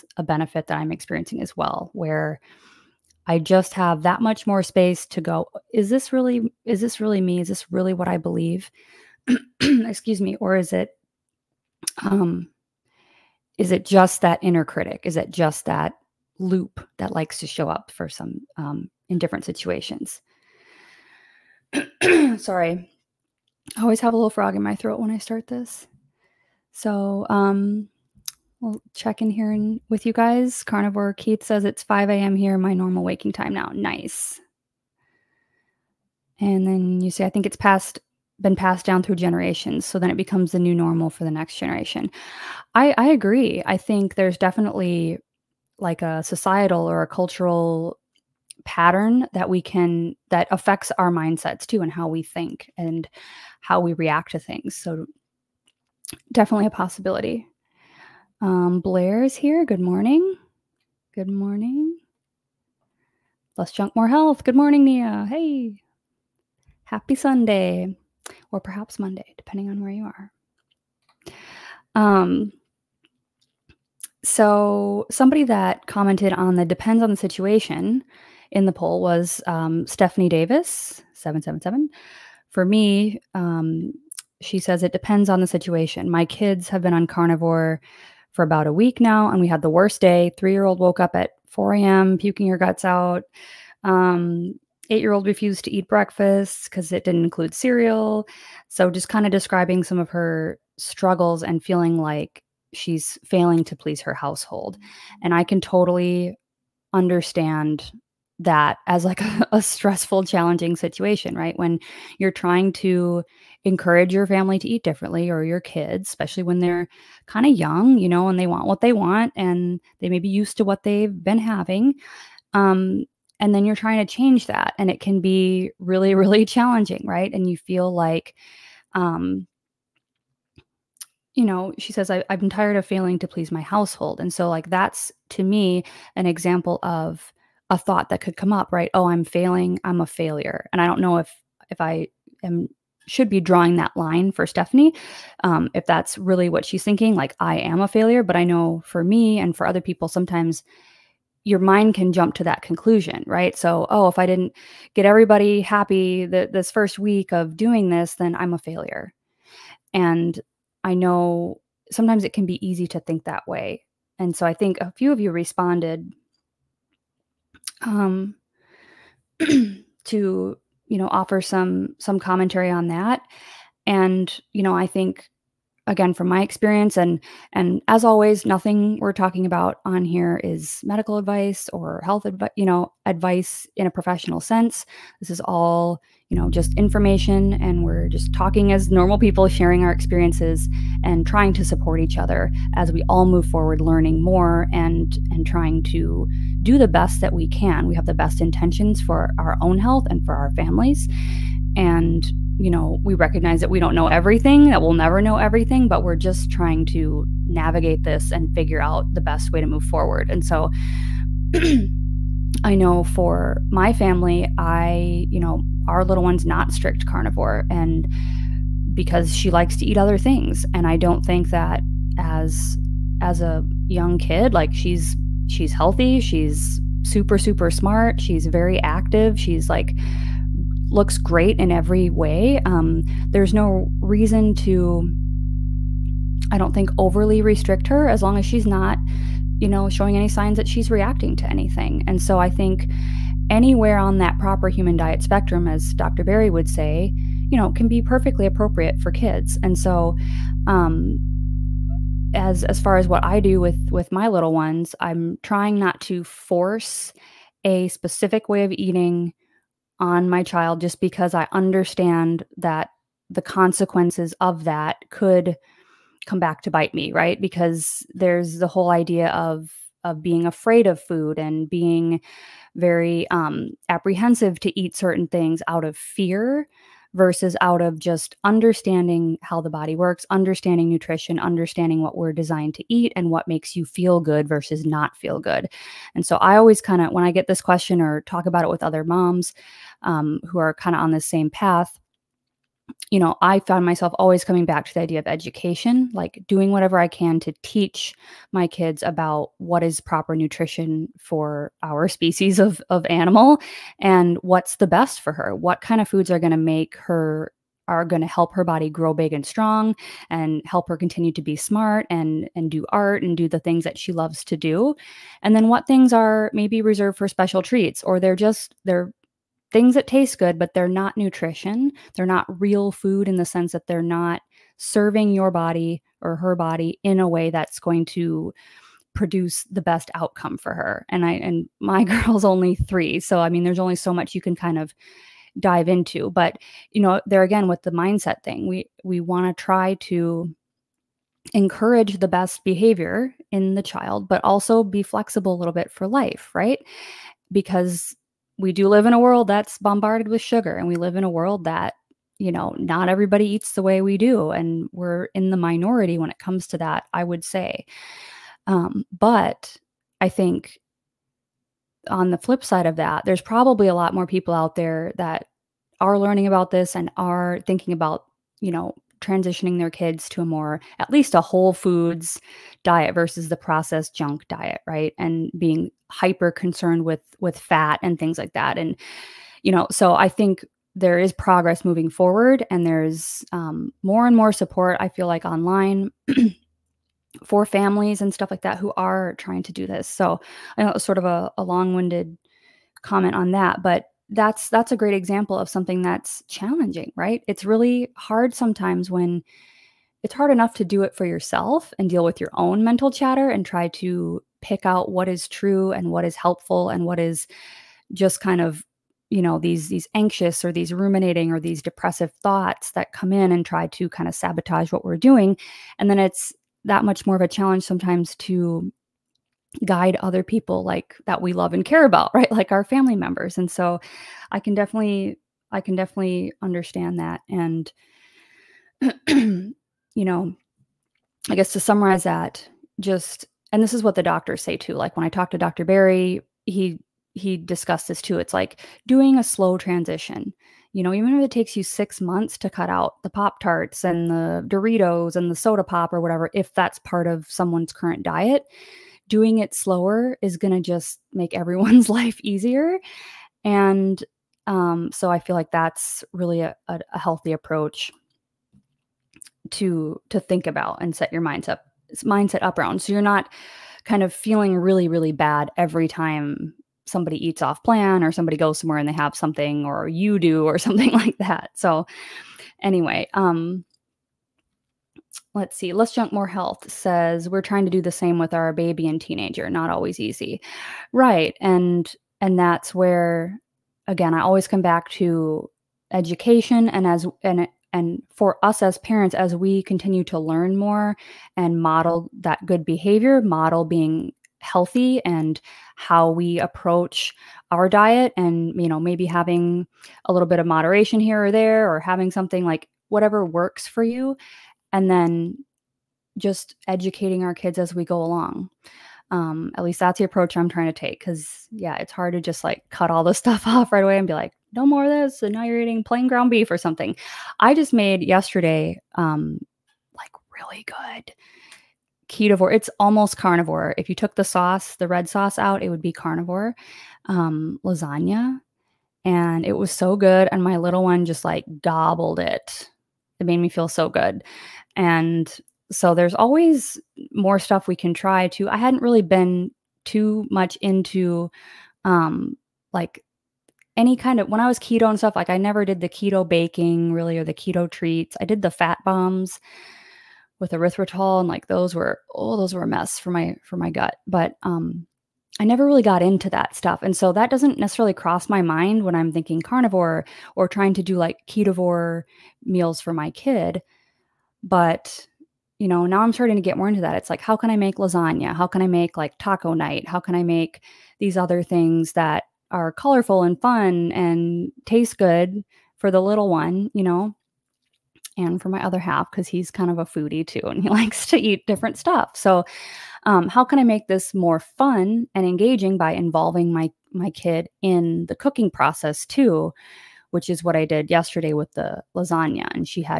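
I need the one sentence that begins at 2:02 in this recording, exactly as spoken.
Um, and then you're trying to change that.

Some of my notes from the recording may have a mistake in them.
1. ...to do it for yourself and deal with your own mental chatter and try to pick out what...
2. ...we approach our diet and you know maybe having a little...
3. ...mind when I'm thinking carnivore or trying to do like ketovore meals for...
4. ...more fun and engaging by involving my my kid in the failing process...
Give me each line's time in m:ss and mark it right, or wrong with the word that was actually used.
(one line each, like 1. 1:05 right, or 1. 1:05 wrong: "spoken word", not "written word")
1. 6:40 right
2. 8:16 right
3. 9:18 right
4. 9:44 wrong: "cooking", not "failing".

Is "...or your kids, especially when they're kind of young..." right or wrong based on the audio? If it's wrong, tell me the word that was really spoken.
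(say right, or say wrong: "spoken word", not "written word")
right.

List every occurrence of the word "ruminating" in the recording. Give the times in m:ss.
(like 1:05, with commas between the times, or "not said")
6:50.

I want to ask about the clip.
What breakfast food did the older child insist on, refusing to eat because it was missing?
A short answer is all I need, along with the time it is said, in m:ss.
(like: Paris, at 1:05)
cereal, at 1:37.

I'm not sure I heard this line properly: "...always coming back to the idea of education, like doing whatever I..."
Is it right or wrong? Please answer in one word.
right.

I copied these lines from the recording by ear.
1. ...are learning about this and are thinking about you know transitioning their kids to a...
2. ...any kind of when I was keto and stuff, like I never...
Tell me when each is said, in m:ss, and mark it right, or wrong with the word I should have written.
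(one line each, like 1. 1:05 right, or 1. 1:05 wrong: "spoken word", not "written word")
1. 6:06 right
2. 9:03 right.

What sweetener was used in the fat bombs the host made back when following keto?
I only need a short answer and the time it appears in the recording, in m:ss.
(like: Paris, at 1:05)
erythritol, at 9:10.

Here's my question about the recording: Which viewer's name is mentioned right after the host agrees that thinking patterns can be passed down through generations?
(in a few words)
Blair.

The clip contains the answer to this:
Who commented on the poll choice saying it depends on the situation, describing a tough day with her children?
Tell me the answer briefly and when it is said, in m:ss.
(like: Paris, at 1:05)
Stephanie Davis, at 1:19.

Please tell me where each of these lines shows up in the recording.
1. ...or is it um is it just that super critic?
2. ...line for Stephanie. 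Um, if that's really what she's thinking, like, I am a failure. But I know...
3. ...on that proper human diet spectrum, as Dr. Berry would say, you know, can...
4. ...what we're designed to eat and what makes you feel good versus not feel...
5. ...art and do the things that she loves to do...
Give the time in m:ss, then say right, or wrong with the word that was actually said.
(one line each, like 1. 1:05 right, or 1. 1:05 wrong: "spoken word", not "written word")
1. 0:10 wrong: "inner", not "super"
2. 2:23 right
3. 4:03 right
4. 4:42 right
5. 5:12 right.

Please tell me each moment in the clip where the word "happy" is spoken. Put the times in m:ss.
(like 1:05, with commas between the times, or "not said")
1:06, 2:35.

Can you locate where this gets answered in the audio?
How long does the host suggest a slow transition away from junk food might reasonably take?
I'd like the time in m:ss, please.
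7:21.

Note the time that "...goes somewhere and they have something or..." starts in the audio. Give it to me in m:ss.
7:48.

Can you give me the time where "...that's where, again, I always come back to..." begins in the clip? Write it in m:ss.
8:02.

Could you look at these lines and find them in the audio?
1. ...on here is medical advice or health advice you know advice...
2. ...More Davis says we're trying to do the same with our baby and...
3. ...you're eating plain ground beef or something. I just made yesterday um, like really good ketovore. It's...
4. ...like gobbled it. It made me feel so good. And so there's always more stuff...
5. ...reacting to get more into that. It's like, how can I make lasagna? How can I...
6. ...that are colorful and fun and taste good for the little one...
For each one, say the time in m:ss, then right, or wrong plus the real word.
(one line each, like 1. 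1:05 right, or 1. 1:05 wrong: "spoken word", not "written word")
1. 2:59 right
2. 7:56 wrong: "Health", not "Davis"
3. 8:35 right
4. 8:51 right
5. 9:26 wrong: "starting", not "reacting"
6. 9:32 right.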